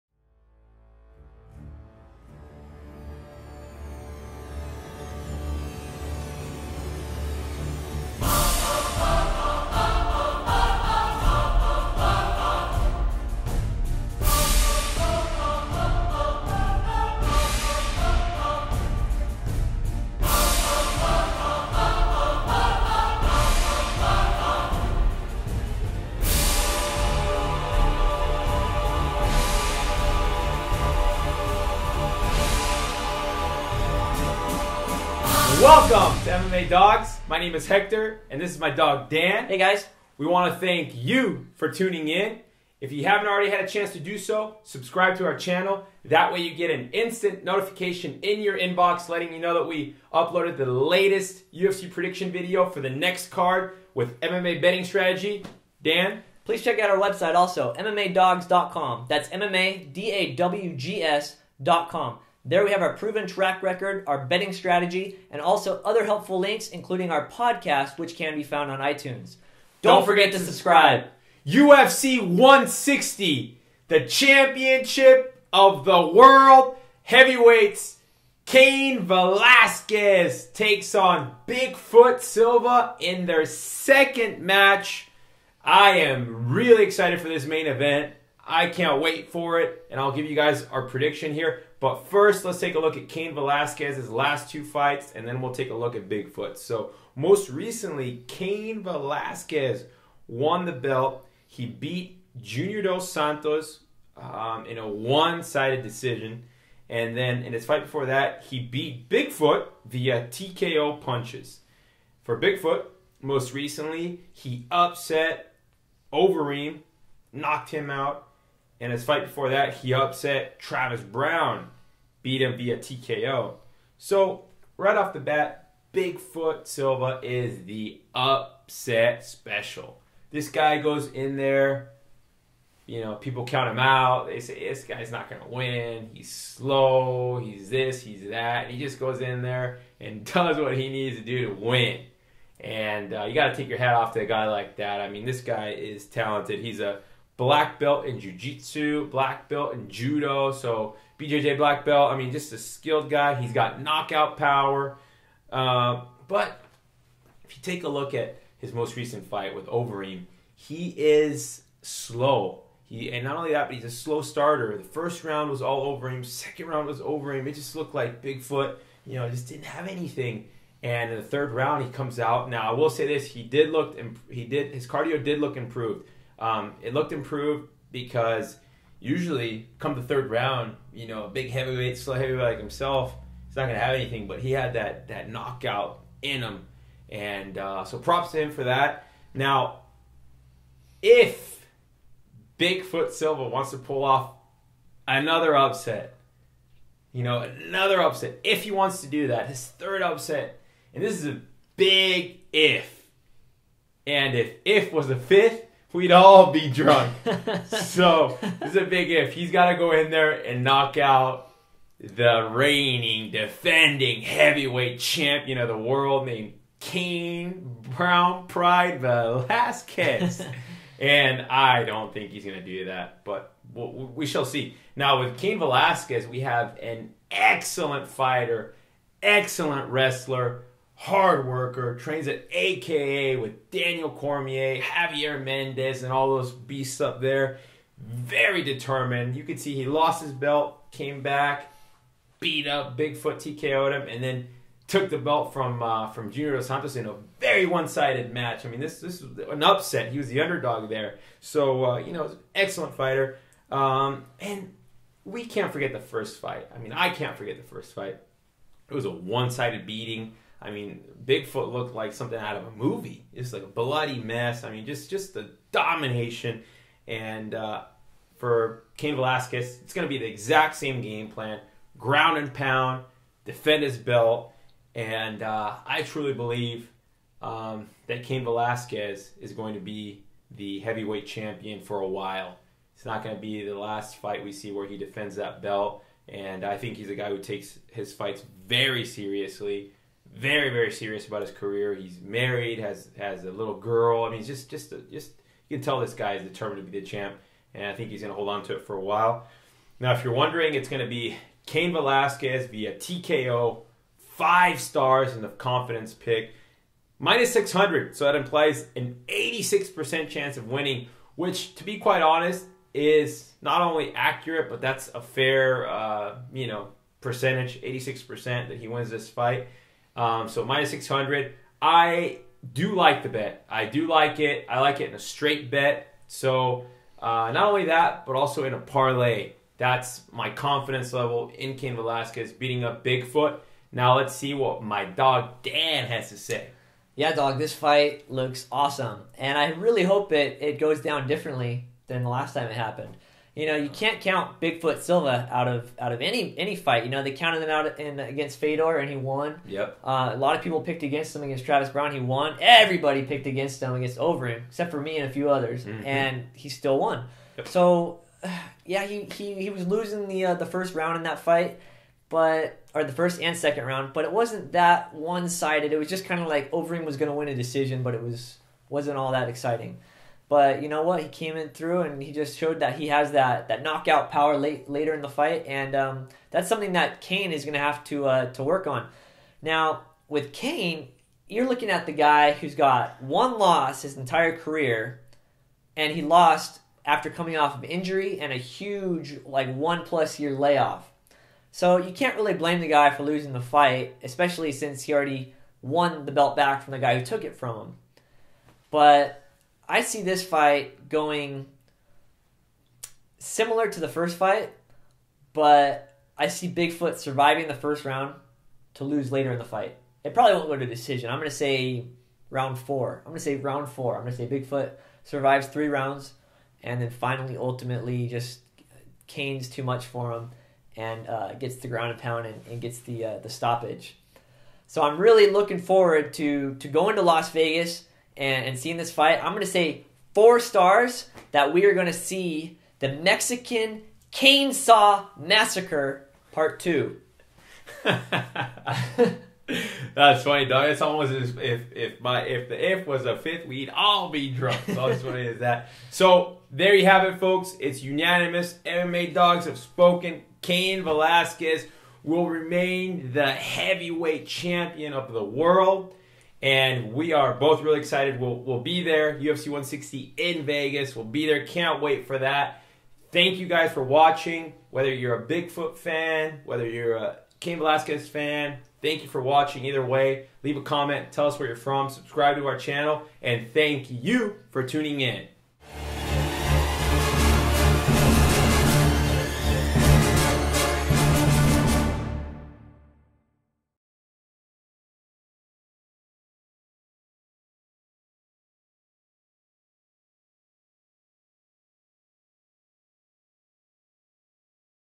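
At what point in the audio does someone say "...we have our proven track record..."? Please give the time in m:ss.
1:02.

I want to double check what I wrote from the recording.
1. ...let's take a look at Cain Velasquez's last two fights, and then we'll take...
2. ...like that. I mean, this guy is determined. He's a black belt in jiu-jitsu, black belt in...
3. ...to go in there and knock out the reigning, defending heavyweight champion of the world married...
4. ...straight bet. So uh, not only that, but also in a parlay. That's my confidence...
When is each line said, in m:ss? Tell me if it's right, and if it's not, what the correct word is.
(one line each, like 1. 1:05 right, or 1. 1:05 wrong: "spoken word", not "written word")
1. 1:32 right
2. 2:24 wrong: "talented", not "determined"
3. 3:29 wrong: "named", not "married"
4. 5:25 right.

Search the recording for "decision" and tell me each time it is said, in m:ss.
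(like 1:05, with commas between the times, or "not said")
1:45, 6:07, 6:50.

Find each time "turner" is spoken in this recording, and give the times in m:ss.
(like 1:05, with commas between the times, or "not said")
not said.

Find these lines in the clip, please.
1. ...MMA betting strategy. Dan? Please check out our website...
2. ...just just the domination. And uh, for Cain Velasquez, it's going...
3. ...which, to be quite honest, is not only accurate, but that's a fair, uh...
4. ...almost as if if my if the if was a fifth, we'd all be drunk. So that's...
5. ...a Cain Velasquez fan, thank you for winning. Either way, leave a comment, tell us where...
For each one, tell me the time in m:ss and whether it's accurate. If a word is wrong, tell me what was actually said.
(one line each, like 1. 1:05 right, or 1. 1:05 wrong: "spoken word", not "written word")
1. 0:54 right
2. 4:24 right
3. 5:11 right
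4. 7:21 right
5. 7:47 wrong: "watching", not "winning".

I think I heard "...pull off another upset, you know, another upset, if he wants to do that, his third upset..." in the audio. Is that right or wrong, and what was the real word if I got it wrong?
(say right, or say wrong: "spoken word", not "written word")
right.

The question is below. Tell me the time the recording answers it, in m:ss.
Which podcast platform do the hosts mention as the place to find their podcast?
1:08.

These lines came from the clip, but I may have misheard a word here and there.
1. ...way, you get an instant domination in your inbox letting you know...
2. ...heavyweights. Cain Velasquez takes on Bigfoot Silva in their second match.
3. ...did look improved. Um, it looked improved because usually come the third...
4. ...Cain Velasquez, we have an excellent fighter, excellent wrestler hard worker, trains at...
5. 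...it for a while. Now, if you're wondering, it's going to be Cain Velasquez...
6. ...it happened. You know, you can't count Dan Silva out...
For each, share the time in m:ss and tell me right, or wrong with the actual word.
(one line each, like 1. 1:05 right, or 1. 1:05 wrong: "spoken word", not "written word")
1. 0:46 wrong: "notification", not "domination"
2. 1:17 right
3. 2:55 right
4. 3:45 right
5. 4:58 right
6. 5:42 wrong: "Bigfoot", not "Dan".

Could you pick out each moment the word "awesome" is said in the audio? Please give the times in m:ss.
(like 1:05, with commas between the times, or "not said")
5:38.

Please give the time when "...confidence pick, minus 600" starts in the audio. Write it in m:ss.
5:05.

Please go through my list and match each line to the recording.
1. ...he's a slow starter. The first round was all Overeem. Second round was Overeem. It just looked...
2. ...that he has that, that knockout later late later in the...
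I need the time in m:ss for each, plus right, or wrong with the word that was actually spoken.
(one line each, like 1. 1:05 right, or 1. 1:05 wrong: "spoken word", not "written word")
1. 2:43 right
2. 6:12 wrong: "power", not "later".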